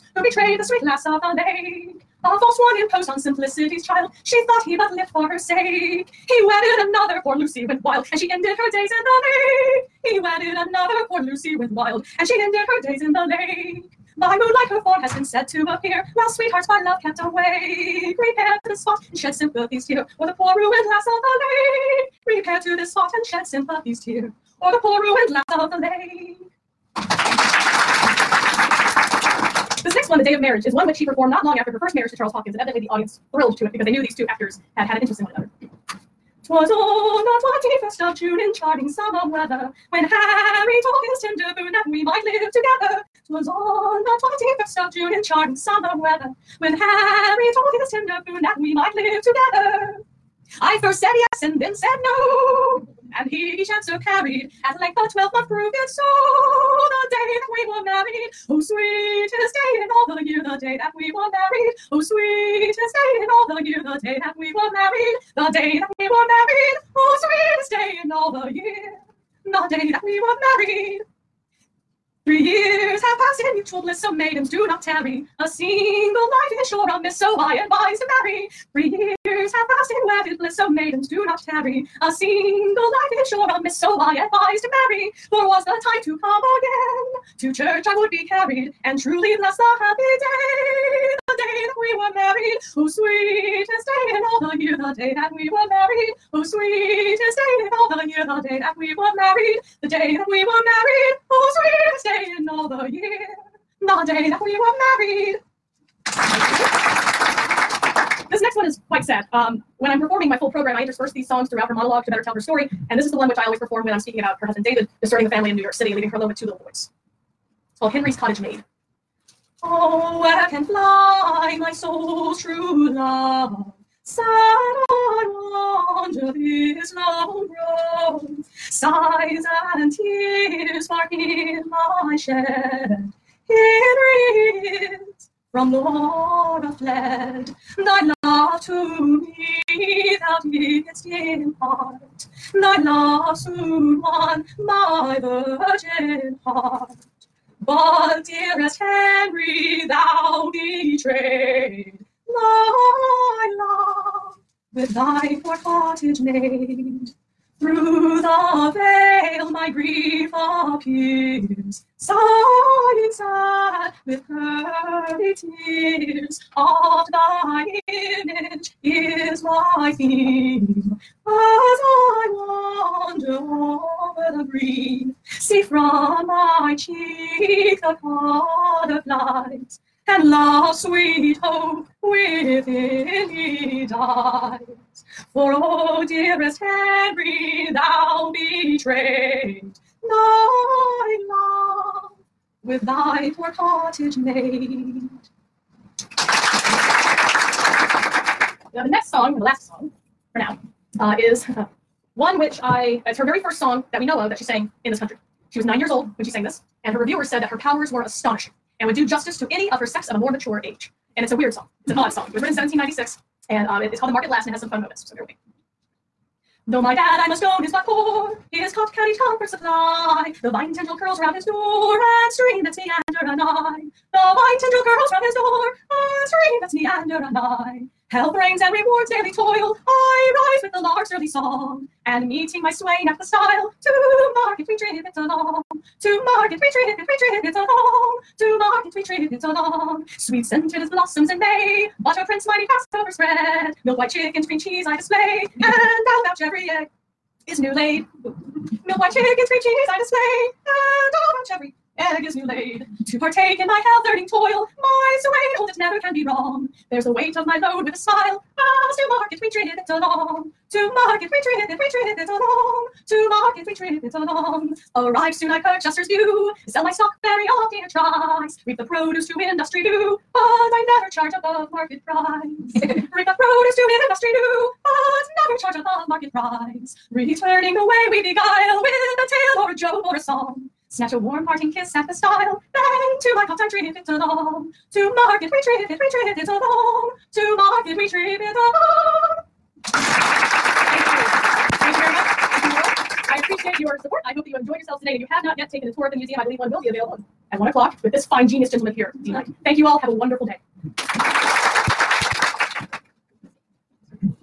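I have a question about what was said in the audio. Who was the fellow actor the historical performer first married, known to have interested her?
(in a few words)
Charles Hopkins.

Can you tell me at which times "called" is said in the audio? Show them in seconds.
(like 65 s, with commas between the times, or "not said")
117 s, 213 s.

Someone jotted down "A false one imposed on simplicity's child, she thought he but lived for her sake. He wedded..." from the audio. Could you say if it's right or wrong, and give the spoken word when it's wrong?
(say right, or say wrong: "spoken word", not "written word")
right.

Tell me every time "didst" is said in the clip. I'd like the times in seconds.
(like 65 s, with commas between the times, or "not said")
140 s.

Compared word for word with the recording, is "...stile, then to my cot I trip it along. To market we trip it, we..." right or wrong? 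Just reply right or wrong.
right.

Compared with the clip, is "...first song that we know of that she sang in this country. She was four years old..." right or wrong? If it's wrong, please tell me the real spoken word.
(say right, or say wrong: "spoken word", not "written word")
wrong: "nine", not "four".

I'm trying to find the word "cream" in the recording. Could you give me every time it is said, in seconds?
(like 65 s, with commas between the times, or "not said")
244 s, 249 s.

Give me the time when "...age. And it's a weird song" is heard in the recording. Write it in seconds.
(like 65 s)
210 s.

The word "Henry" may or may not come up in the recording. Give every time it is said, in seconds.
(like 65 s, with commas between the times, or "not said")
117 s, 148 s.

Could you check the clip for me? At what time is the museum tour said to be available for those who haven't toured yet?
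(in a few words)
1 o'clock.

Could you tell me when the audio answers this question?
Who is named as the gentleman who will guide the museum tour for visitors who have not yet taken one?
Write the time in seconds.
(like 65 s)
299 s.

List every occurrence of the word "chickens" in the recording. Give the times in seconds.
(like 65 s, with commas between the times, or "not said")
244 s, 249 s.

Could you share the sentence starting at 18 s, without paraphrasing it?
Prepare to the spot and shed sympathy's tear o'er the poor ruined lass of the lake.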